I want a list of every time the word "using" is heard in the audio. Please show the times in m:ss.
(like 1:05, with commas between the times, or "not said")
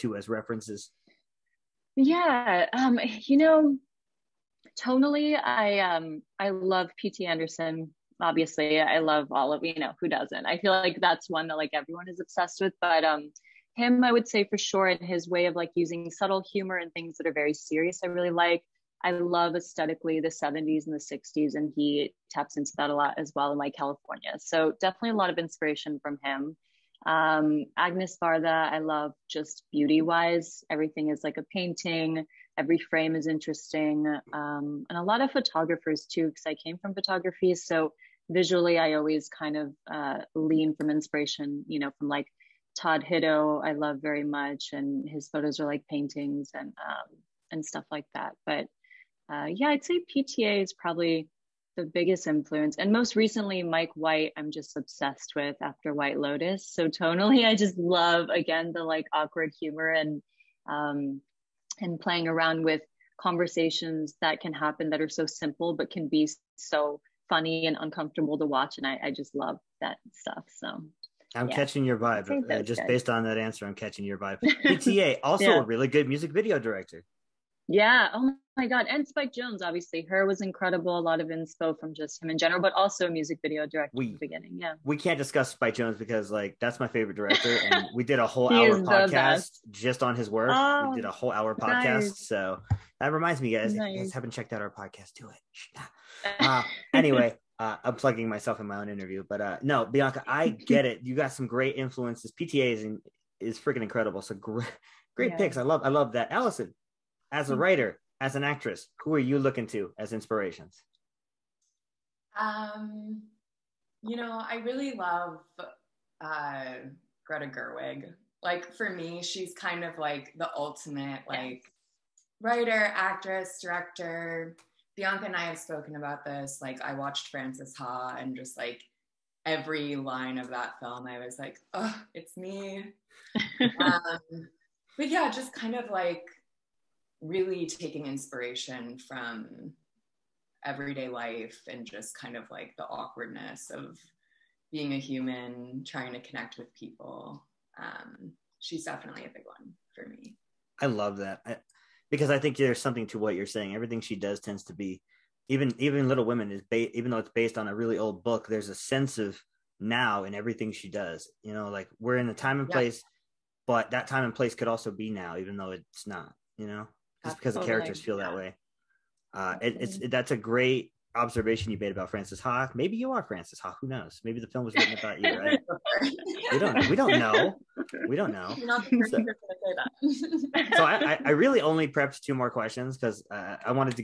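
0:15.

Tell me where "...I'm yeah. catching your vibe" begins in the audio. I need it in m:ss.
1:11.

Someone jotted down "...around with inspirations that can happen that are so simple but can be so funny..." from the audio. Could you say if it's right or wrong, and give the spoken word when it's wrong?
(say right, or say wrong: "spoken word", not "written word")
wrong: "conversations", not "inspirations".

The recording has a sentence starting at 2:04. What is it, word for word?
Bianca and I have spoken about this.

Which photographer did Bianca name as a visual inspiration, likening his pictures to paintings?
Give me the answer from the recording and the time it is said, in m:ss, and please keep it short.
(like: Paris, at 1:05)
Todd Hido, at 0:42.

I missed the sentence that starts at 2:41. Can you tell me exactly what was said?
You know, like we're in a time and yeah.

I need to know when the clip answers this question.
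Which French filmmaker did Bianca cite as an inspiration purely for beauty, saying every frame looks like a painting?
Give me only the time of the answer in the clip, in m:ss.
0:27.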